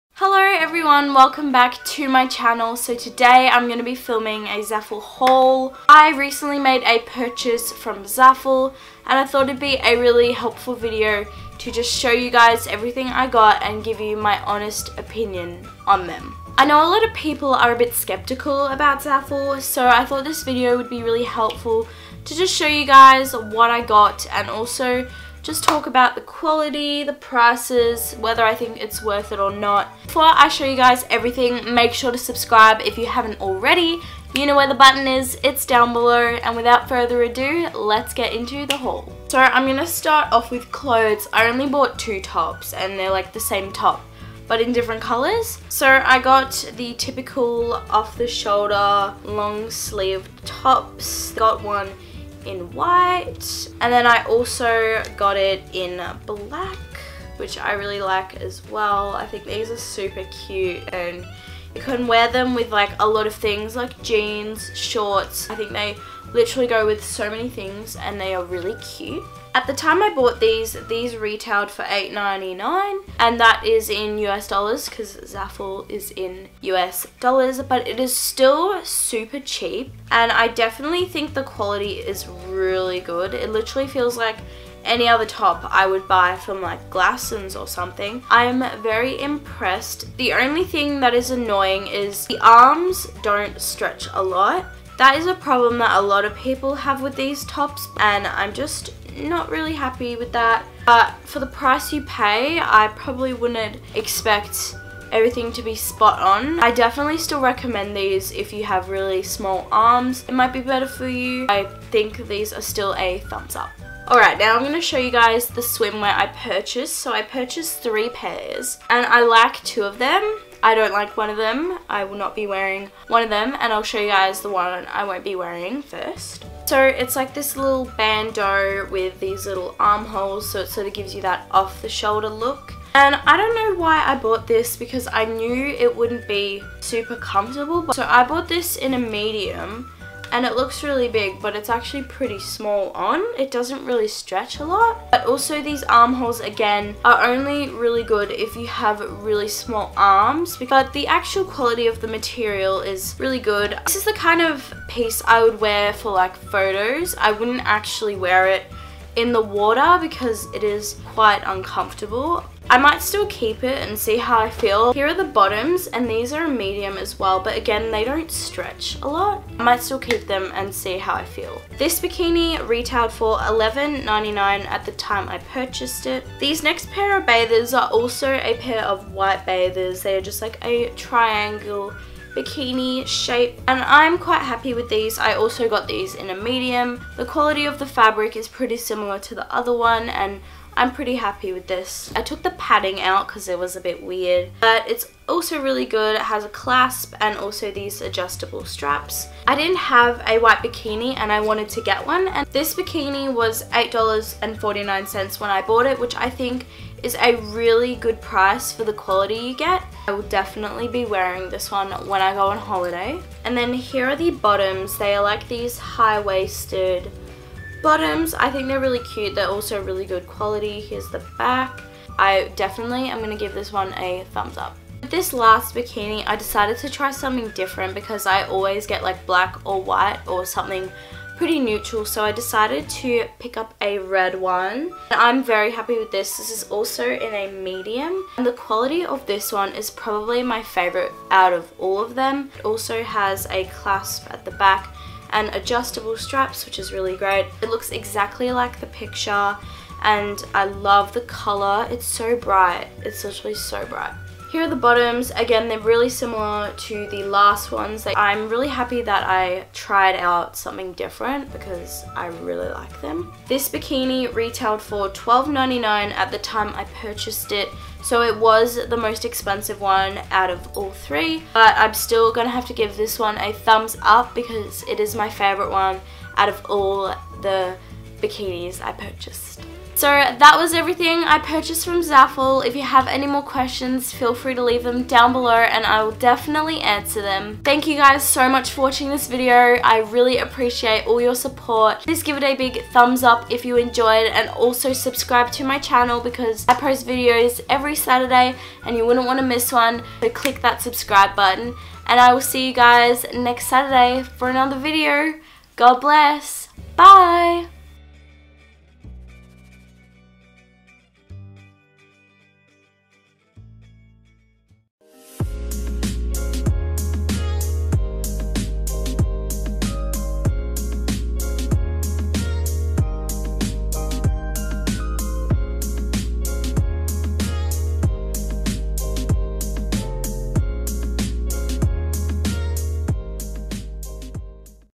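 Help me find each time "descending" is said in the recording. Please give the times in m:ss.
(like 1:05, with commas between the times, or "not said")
not said.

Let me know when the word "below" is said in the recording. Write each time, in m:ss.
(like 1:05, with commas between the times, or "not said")
0:35, 4:45.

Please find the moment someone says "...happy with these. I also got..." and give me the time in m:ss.
3:04.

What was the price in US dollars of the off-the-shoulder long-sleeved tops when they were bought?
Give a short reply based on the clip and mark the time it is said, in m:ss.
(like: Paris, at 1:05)
$8.99, at 1:11.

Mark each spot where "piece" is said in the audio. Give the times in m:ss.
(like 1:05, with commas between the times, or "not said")
2:34.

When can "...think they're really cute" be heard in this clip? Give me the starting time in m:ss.
3:38.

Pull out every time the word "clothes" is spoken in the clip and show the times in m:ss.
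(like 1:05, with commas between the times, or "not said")
0:40.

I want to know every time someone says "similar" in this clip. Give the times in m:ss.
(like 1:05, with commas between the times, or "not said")
3:08, 4:16.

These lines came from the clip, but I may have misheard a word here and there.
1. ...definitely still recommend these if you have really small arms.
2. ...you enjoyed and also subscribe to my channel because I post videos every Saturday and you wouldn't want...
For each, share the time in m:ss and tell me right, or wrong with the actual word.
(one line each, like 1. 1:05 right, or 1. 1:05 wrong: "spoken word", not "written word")
1. 1:46 right
2. 4:53 right.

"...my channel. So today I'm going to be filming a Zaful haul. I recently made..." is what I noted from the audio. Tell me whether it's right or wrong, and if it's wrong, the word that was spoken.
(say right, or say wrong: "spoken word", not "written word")
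right.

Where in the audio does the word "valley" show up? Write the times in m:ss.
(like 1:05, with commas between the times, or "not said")
not said.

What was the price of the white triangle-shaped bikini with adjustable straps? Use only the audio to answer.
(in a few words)
$8.49.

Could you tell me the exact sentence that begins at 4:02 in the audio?
It also has a clasp at the back and adjustable straps, which is really great.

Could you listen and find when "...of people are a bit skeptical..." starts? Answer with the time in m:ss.
0:17.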